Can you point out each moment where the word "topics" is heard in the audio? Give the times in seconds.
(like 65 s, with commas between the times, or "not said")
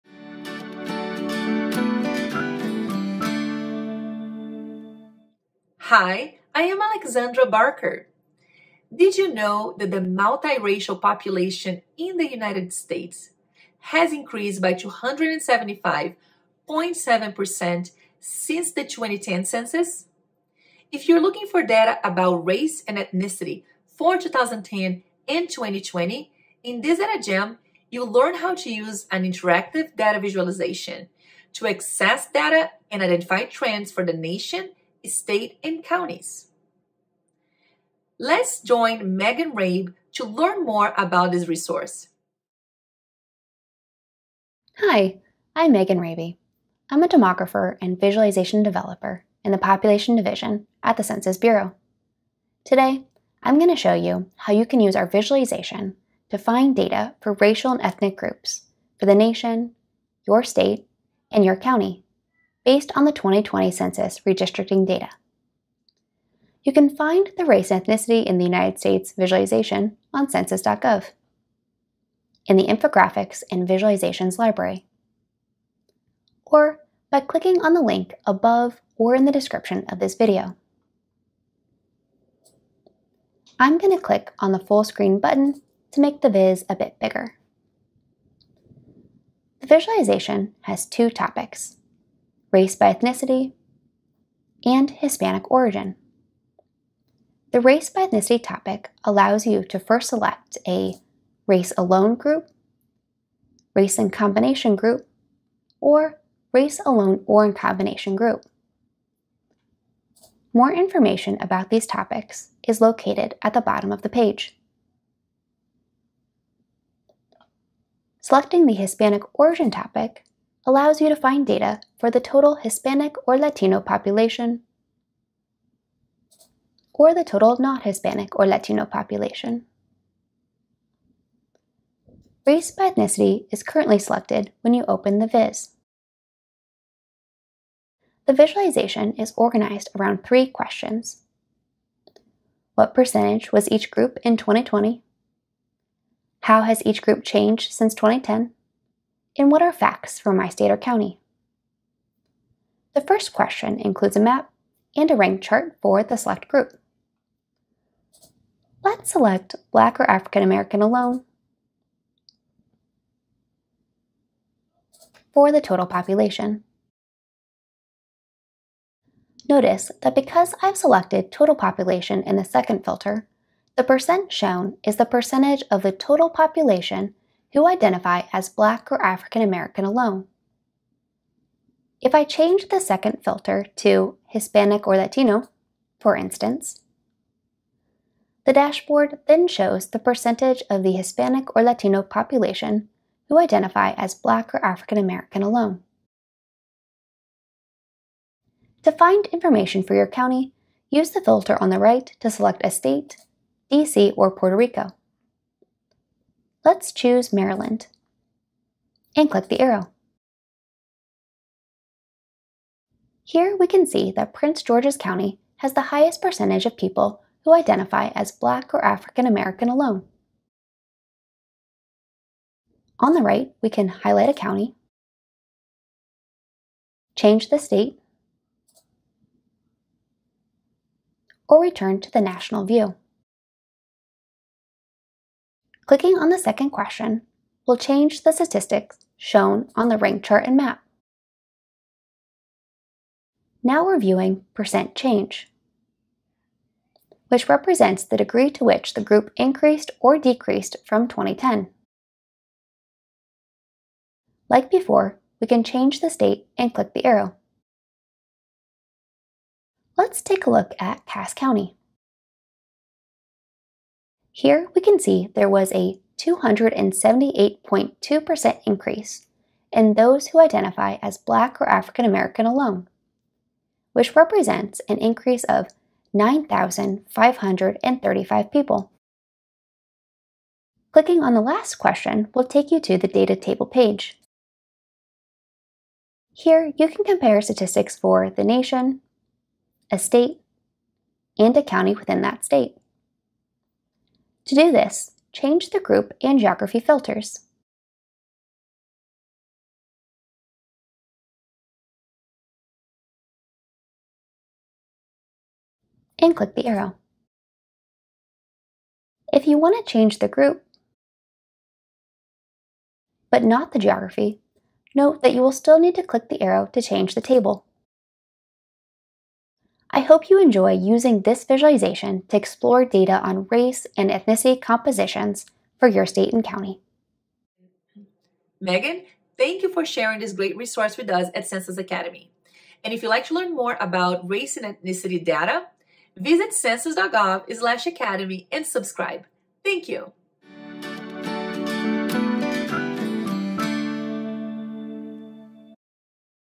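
91 s, 98 s, 111 s, 119 s.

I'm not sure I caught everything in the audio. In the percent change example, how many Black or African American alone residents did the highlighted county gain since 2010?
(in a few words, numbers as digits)
9,535.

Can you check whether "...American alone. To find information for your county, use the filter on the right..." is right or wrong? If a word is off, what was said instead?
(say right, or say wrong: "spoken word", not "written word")
right.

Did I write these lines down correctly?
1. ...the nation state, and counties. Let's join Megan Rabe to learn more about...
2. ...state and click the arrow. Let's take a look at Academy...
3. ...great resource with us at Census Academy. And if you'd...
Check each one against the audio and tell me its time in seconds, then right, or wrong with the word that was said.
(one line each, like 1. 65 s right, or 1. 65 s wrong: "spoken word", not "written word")
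1. 34 s right
2. 256 s wrong: "Cass", not "Academy"
3. 330 s right.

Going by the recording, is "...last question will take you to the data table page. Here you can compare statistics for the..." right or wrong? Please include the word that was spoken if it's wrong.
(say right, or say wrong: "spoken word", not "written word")
right.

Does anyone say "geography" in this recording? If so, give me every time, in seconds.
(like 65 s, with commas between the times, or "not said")
296 s, 313 s.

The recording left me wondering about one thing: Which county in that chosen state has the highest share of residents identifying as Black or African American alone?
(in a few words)
Prince George's County.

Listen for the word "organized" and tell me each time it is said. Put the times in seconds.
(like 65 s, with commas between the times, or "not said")
139 s.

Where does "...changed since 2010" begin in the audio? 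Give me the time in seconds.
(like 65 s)
147 s.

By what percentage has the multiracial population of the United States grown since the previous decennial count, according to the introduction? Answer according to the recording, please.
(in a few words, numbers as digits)
275.7%.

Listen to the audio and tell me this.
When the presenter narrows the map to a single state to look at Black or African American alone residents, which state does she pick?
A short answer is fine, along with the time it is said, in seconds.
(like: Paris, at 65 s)
Maryland, at 207 s.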